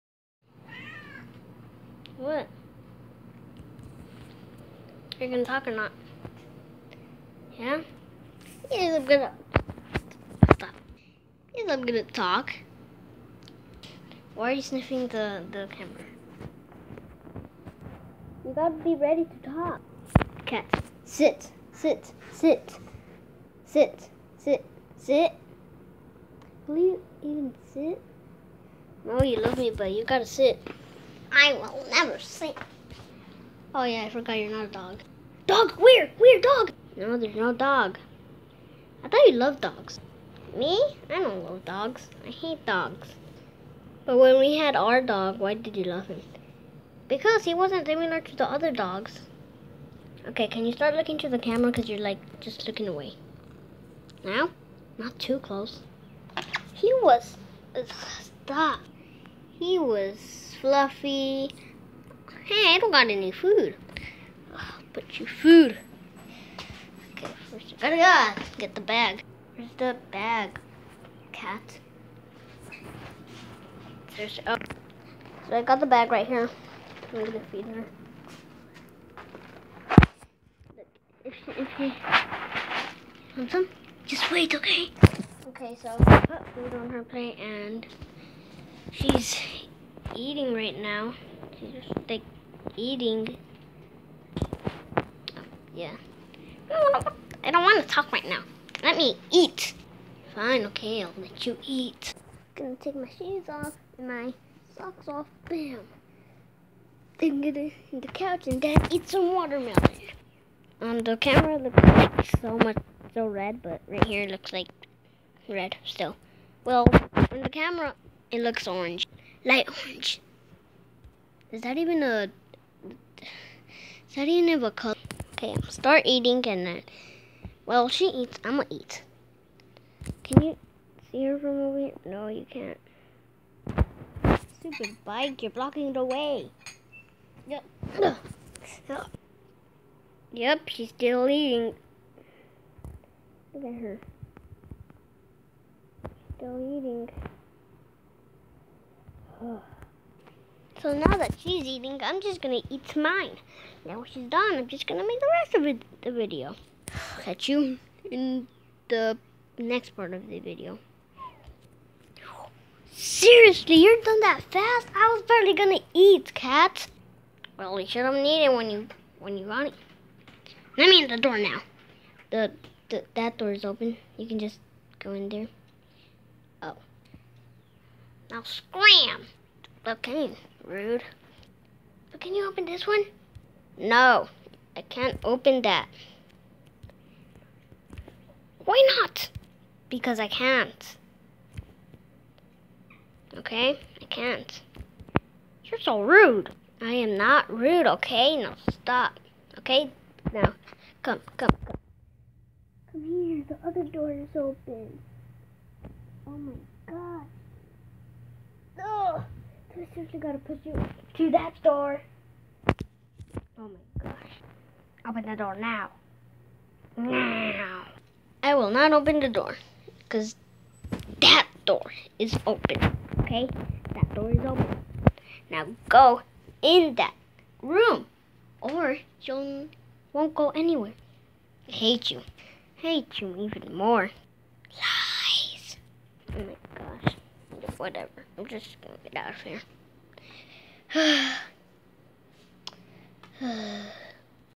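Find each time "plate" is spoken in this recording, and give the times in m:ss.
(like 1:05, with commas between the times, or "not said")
1:27.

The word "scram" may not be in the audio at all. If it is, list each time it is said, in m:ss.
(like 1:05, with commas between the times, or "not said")
2:58.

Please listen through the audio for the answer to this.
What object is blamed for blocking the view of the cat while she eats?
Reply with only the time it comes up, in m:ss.
2:15.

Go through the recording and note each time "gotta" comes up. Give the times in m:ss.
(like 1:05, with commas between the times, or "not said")
0:18, 0:30, 3:30.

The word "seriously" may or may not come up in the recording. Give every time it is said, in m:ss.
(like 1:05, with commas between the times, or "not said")
2:42, 3:29.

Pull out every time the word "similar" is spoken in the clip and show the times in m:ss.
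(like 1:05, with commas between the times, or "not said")
0:47.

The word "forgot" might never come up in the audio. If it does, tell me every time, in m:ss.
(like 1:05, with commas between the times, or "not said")
0:34.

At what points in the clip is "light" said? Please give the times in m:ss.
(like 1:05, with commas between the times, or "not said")
1:59.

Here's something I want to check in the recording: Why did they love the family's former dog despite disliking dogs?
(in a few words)
fluffy.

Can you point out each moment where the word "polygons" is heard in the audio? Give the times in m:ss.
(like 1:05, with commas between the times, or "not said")
not said.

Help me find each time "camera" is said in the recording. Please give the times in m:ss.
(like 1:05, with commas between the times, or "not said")
0:15, 0:51, 1:51, 1:57.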